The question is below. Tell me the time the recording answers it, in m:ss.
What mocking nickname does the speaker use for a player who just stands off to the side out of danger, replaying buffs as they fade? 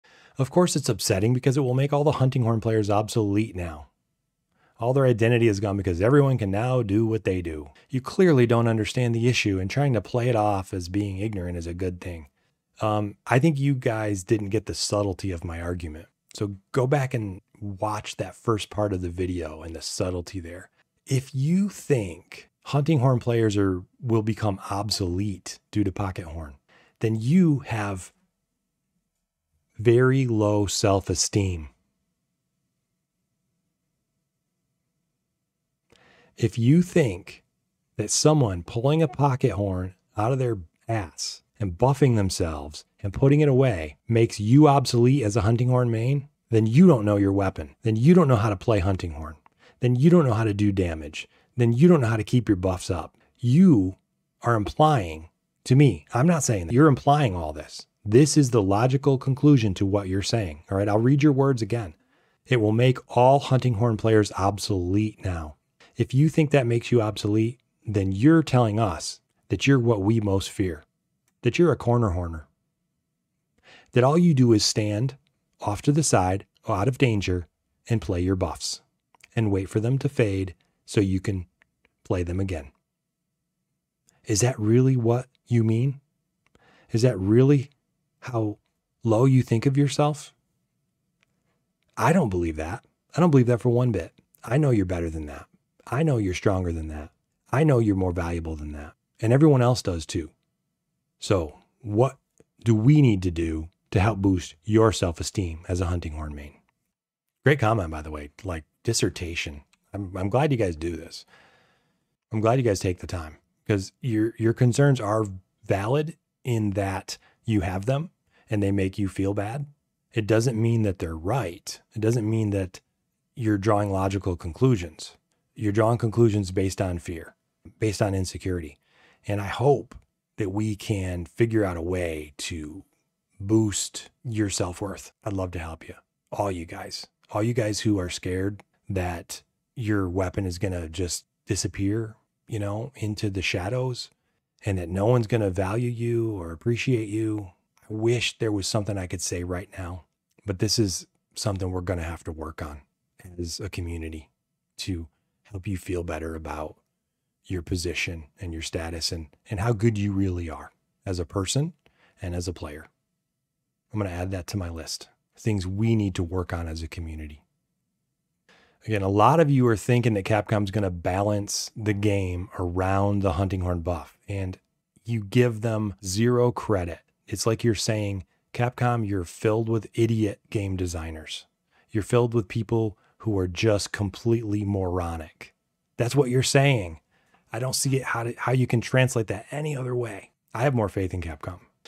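1:11.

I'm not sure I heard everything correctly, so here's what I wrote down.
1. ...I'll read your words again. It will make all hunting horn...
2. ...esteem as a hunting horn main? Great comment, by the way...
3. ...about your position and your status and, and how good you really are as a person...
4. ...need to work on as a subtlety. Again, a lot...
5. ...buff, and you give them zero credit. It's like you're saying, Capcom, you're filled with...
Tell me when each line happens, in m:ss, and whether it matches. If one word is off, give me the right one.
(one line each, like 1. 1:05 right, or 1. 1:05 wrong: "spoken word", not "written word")
1. 1:00 right
2. 1:45 right
3. 2:36 right
4. 2:45 wrong: "community", not "subtlety"
5. 2:53 right.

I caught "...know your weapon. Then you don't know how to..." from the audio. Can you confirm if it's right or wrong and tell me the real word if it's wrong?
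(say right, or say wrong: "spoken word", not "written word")
right.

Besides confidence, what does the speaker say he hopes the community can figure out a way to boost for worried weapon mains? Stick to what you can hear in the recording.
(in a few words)
self worth.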